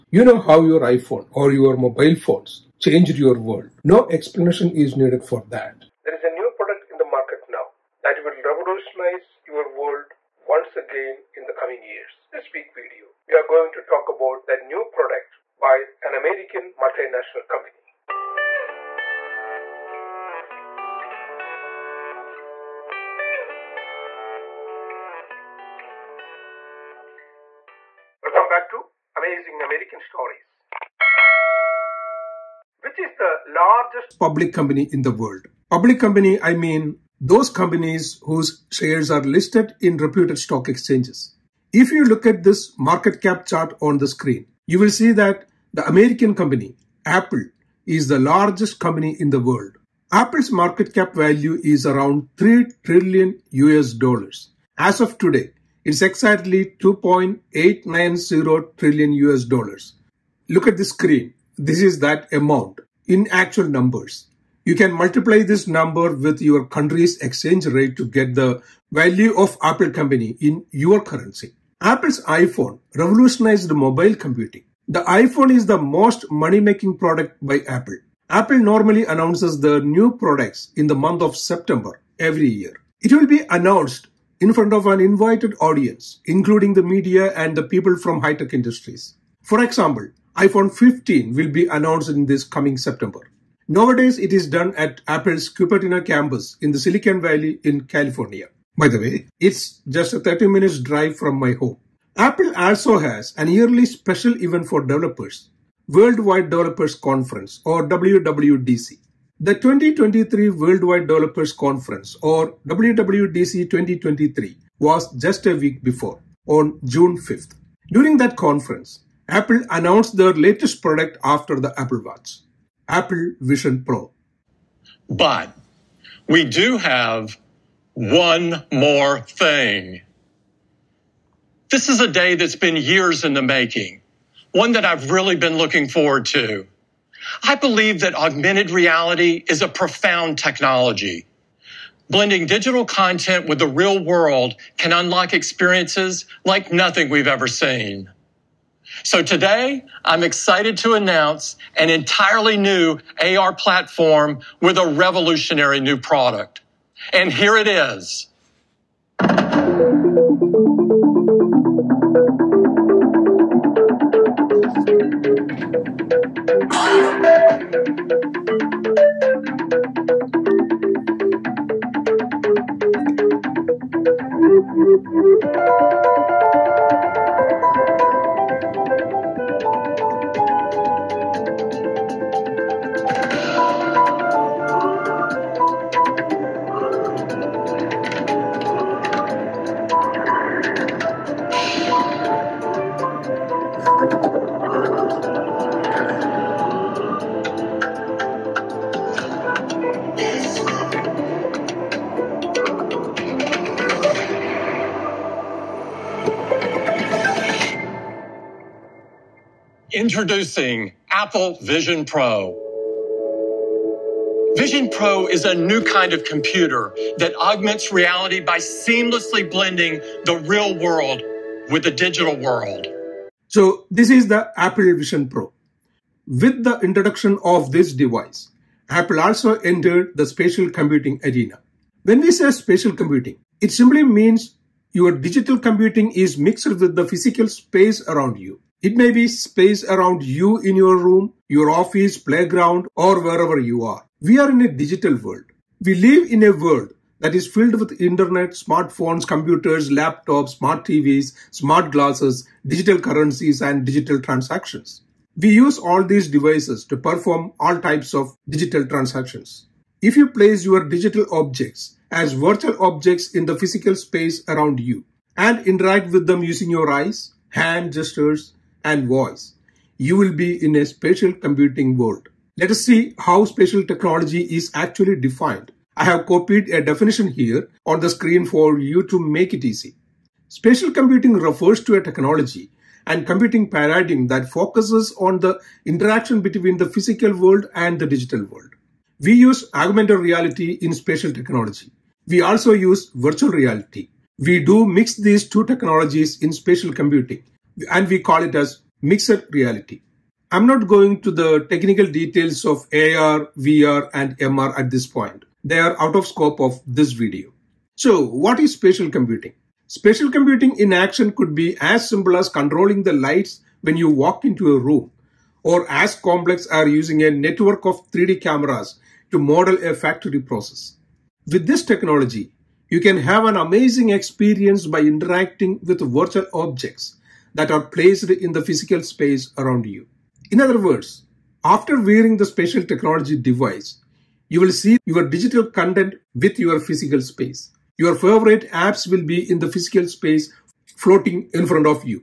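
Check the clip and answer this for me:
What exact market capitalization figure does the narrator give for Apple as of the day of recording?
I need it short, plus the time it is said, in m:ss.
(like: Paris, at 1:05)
2.890 trillion US dollars, at 0:56.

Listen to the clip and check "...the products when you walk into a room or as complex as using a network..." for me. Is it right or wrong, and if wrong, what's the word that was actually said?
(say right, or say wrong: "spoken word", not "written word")
wrong: "lights", not "products".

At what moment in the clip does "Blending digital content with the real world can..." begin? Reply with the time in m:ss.
2:22.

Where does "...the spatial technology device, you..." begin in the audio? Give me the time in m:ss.
5:32.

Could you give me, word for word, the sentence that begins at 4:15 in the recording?
We use all these devices to perform all types of digital transactions.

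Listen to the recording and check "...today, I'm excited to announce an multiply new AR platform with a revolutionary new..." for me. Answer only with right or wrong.
wrong.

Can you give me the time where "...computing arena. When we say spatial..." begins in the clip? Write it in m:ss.
3:50.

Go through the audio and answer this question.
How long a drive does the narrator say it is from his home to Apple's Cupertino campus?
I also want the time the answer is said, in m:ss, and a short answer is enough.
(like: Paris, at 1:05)
30 minutes, at 1:40.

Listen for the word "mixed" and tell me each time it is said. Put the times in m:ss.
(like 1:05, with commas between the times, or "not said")
3:56, 4:59.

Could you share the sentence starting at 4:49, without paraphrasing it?
We use augmented reality in spatial technology.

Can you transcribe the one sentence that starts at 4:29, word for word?
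You will be in a spatial computing world.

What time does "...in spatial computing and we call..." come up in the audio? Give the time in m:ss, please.
4:56.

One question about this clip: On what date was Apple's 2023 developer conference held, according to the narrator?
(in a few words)
June 5th.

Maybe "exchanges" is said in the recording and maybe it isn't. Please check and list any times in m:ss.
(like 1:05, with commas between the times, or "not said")
0:40, 1:07.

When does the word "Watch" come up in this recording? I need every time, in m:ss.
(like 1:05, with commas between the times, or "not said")
2:02.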